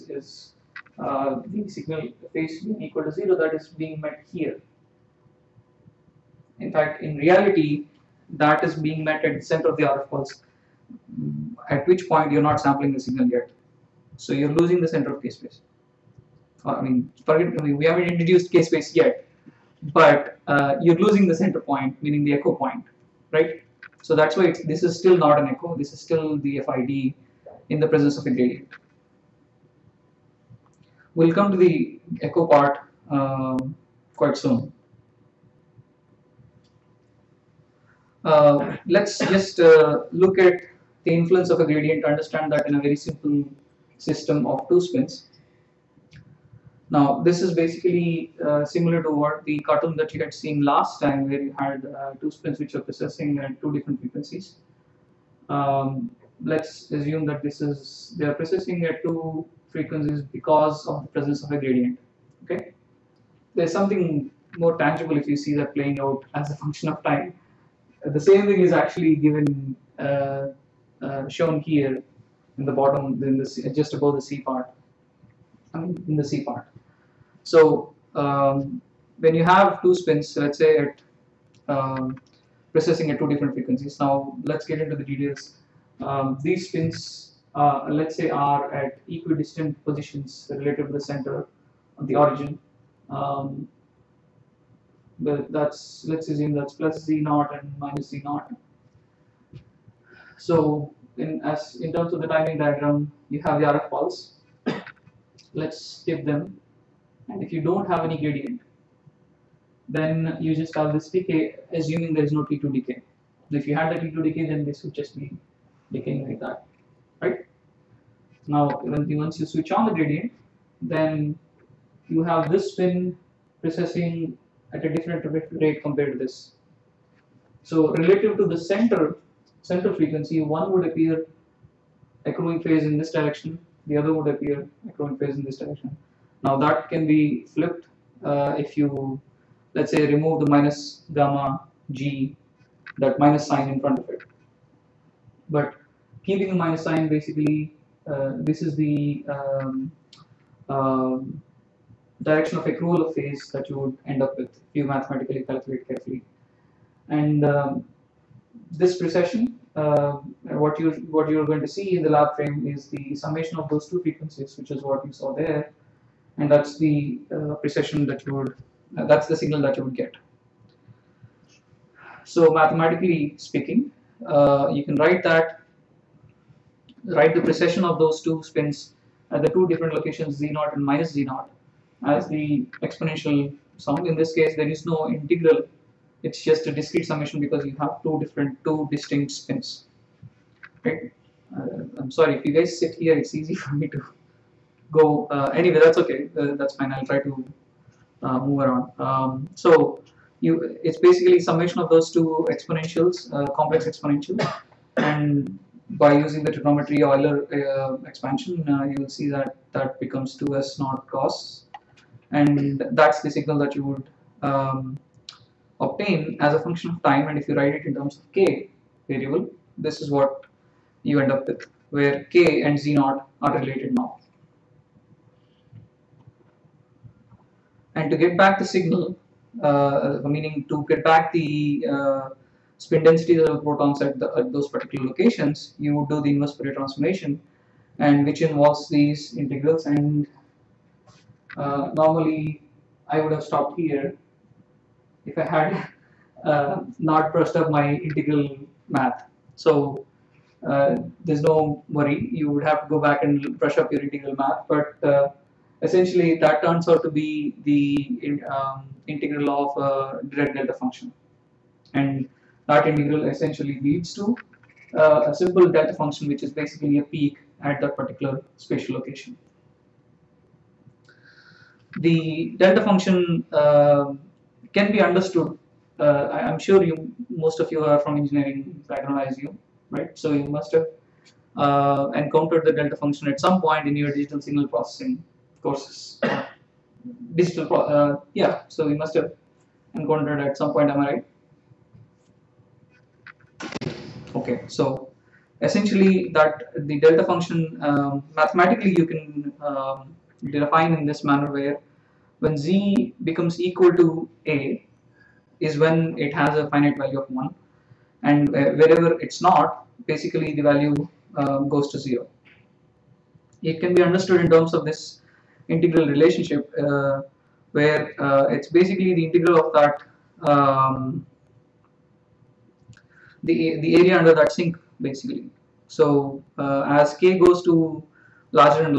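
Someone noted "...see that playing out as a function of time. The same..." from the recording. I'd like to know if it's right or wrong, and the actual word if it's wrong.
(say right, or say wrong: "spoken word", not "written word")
right.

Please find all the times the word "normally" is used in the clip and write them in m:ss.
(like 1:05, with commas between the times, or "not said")
4:01.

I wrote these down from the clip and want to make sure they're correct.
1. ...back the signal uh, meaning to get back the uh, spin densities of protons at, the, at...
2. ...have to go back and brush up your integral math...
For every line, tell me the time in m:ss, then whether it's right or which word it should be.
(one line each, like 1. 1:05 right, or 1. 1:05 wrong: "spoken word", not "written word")
1. 3:48 right
2. 4:12 right.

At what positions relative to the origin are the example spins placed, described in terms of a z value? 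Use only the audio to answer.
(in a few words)
plus z naught and minus z naught.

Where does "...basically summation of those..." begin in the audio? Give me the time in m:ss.
3:21.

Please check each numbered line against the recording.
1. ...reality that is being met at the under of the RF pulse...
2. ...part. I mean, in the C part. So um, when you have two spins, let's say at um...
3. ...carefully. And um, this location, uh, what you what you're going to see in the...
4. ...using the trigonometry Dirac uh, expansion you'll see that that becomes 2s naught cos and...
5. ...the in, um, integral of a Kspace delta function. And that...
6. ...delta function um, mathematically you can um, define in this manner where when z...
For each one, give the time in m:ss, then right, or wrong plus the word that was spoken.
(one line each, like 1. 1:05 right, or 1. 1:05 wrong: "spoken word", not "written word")
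1. 0:07 wrong: "center", not "under"
2. 1:14 right
3. 2:35 wrong: "precession", not "location"
4. 3:26 wrong: "Euler", not "Dirac"
5. 4:17 wrong: "Dirac", not "Kspace"
6. 4:57 right.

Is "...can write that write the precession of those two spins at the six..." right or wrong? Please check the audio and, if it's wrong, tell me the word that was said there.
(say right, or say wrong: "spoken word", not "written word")
wrong: "two", not "six".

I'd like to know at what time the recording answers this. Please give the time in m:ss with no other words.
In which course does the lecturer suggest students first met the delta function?
4:44.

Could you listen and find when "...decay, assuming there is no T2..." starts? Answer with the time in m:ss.
1:51.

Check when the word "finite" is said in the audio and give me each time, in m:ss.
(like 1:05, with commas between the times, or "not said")
5:06.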